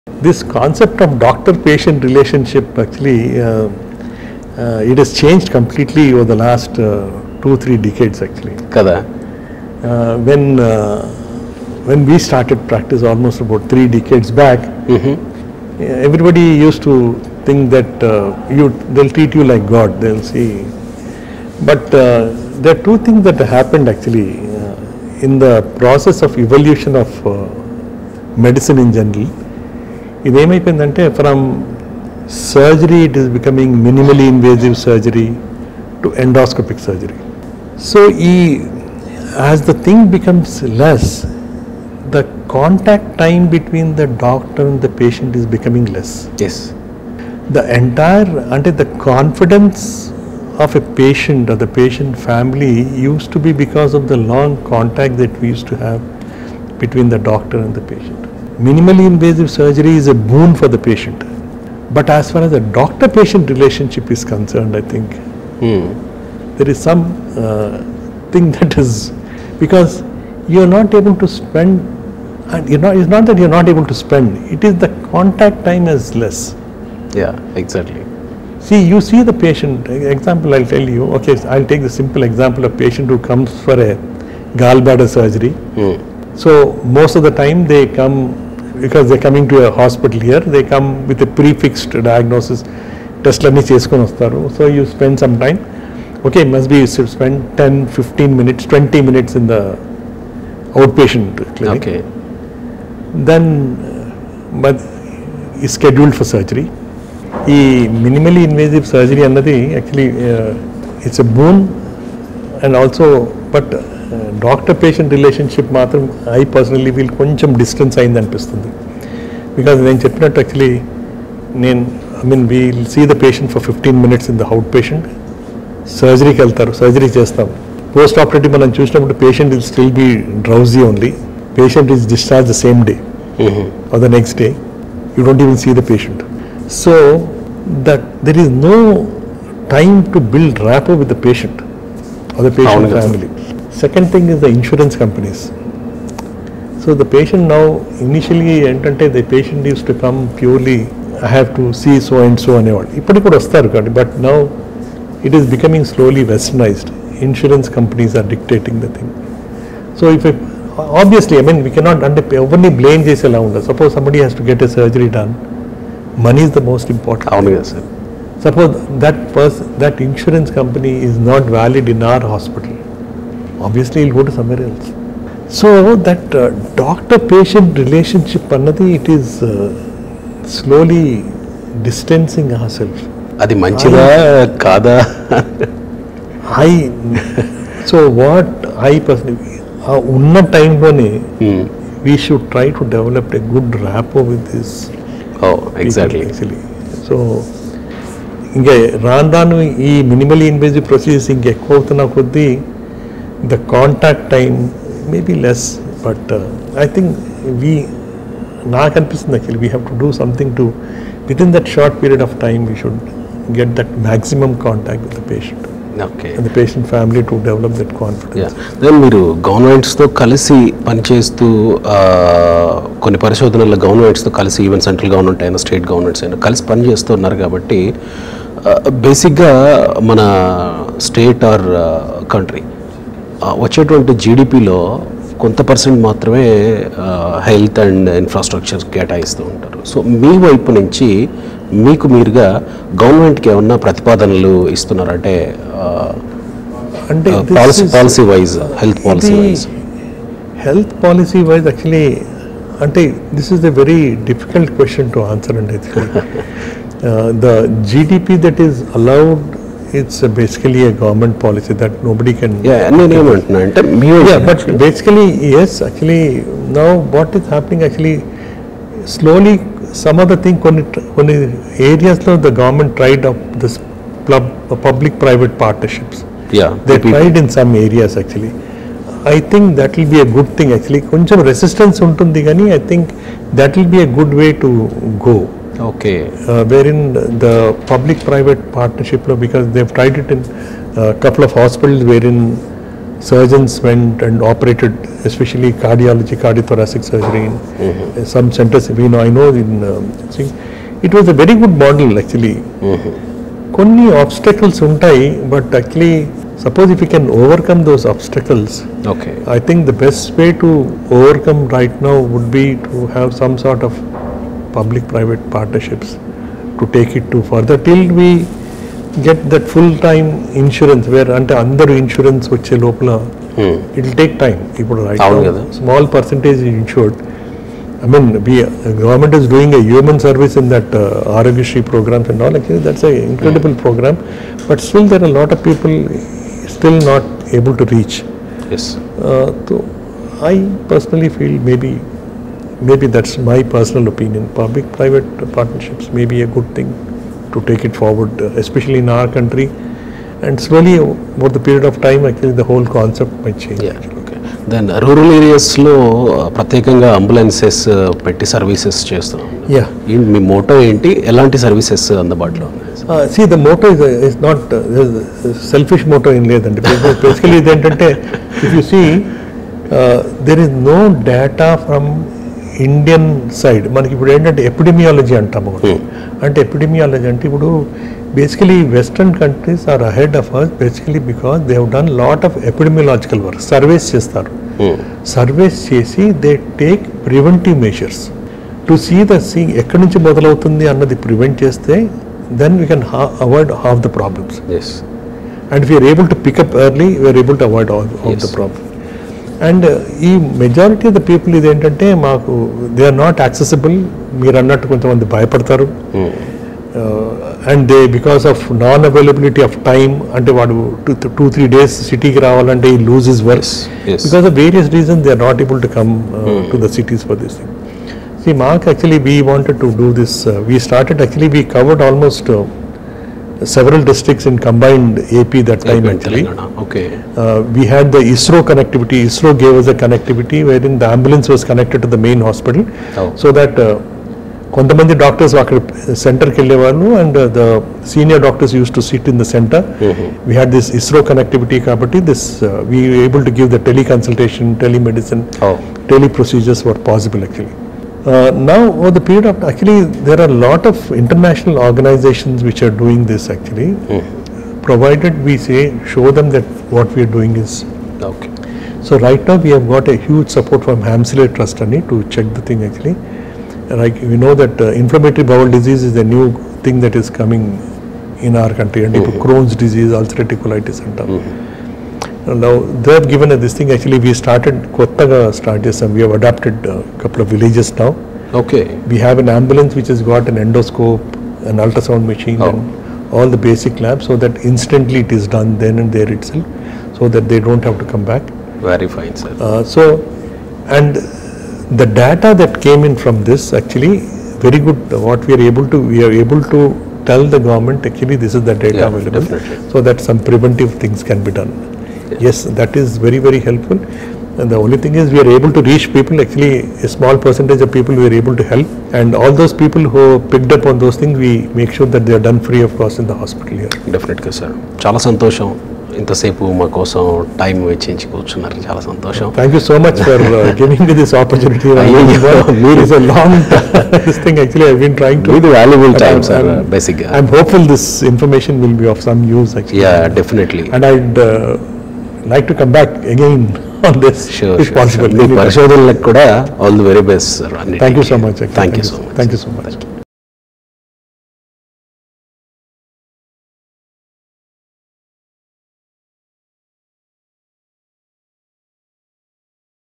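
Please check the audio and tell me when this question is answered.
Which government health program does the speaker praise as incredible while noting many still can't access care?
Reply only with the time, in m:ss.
5:31.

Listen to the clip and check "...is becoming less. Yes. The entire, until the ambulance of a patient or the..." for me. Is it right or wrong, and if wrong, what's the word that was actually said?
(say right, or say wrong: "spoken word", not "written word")
wrong: "confidence", not "ambulance".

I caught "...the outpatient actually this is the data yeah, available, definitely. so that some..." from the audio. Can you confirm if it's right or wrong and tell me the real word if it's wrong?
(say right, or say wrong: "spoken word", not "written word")
wrong: "government", not "outpatient".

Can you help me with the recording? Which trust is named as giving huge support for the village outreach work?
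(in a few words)
Helmsley Trust.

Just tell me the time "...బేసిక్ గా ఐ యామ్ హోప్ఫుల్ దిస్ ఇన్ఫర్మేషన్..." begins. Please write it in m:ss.
8:46.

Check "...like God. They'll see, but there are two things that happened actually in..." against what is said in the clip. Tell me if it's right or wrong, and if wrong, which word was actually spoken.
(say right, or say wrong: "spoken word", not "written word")
right.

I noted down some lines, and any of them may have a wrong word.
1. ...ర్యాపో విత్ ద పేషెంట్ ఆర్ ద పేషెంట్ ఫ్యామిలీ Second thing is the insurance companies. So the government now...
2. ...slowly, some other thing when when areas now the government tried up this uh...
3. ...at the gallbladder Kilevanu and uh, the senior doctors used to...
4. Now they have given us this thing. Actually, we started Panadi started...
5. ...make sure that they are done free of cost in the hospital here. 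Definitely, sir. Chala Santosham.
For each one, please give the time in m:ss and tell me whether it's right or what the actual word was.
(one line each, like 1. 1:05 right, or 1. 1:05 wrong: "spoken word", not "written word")
1. 2:20 wrong: "patient", not "government"
2. 4:29 right
3. 7:15 wrong: "center", not "gallbladder"
4. 7:52 wrong: "Kottaga", not "Panadi"
5. 8:31 right.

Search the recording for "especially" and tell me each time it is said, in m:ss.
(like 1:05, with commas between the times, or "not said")
4:55, 5:48.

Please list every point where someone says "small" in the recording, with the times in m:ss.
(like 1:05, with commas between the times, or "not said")
5:25, 8:27.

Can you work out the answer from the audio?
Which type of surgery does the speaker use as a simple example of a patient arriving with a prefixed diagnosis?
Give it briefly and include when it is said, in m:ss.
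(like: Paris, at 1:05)
Gallbladder surgery, at 1:24.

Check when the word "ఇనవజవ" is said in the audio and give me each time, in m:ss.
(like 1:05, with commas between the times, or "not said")
0:34, 3:20.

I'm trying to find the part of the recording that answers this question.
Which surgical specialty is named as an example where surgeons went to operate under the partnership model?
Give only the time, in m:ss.
4:56.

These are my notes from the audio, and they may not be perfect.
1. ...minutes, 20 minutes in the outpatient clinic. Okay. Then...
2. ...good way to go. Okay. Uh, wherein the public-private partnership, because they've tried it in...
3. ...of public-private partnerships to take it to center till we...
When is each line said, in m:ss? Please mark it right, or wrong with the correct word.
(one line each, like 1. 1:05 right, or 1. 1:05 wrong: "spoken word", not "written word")
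1. 1:38 right
2. 4:44 right
3. 5:13 wrong: "further", not "center".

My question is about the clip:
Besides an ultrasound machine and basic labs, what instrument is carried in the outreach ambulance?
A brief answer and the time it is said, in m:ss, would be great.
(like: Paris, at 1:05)
Endoscope, at 8:00.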